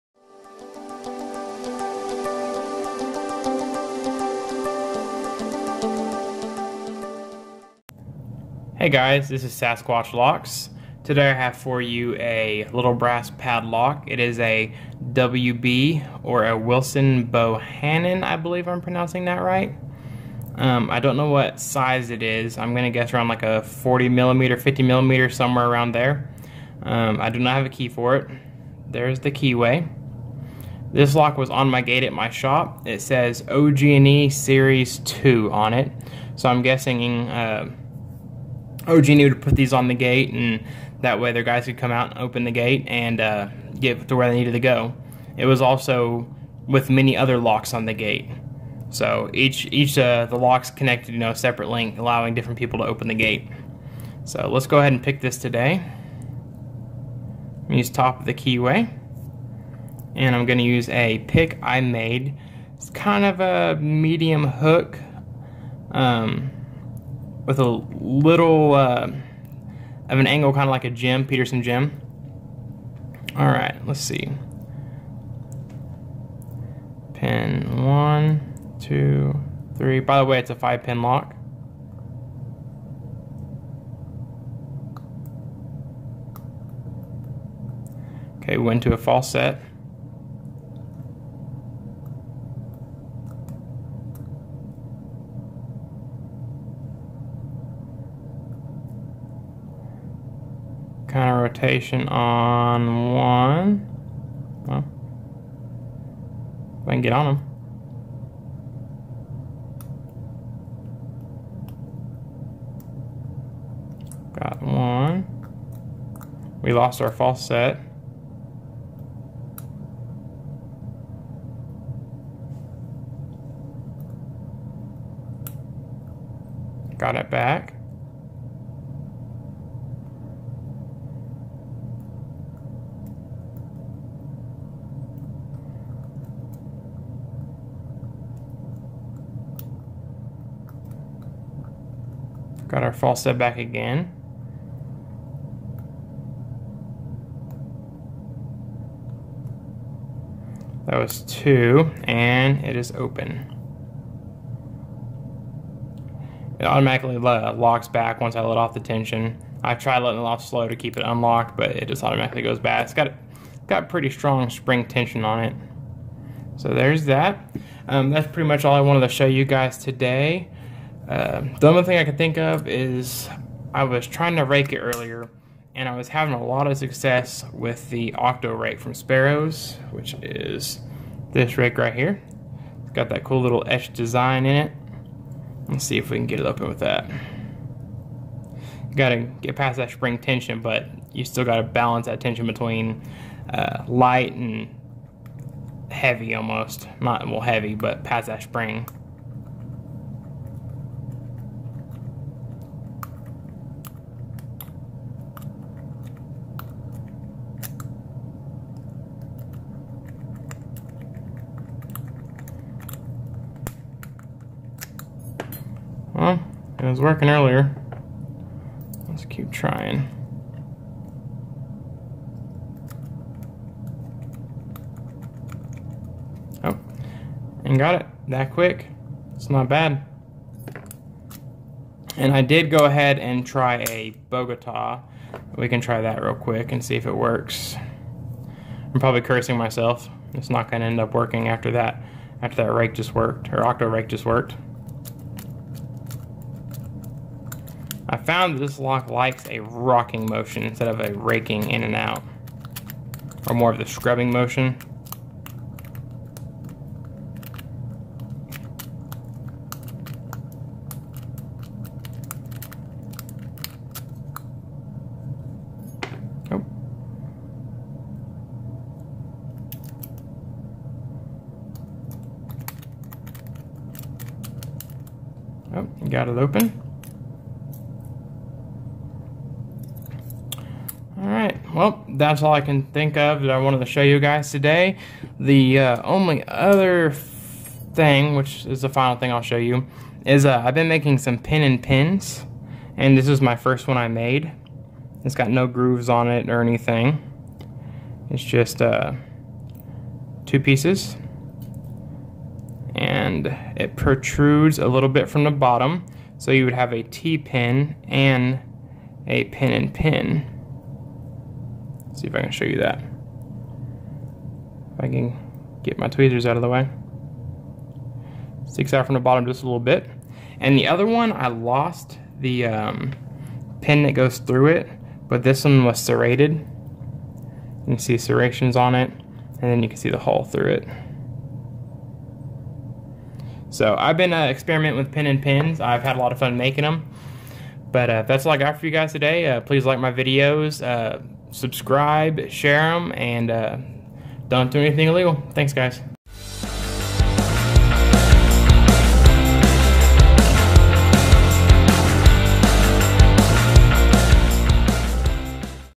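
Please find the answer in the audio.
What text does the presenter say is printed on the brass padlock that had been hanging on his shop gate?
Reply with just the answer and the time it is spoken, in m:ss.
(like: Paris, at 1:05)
OG&E Series 2, at 0:33.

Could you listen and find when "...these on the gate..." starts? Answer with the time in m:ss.
0:39.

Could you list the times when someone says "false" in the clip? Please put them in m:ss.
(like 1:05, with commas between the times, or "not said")
1:28, 1:57, 2:22.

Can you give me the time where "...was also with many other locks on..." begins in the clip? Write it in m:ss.
0:45.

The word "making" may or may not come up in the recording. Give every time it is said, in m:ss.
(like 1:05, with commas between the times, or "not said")
4:50, 5:36.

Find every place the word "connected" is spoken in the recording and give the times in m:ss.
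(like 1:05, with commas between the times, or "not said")
0:50.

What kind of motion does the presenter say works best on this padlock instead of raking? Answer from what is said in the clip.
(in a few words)
A rocking motion.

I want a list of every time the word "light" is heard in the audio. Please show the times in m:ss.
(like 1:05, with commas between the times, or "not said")
3:13.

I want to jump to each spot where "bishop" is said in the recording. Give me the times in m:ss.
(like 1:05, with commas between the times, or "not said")
not said.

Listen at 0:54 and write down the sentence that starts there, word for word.
So let's go ahead and pick this today.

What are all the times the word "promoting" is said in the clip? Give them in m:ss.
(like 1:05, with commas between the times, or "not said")
not said.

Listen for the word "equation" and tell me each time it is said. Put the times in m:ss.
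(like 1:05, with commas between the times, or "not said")
not said.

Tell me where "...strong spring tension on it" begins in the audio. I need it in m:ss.
2:44.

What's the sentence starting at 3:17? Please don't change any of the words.
Not well heavy, but past that spring.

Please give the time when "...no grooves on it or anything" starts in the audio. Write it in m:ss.
4:55.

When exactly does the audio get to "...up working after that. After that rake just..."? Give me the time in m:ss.
4:00.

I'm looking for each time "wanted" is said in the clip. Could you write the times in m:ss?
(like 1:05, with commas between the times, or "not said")
2:48, 4:43.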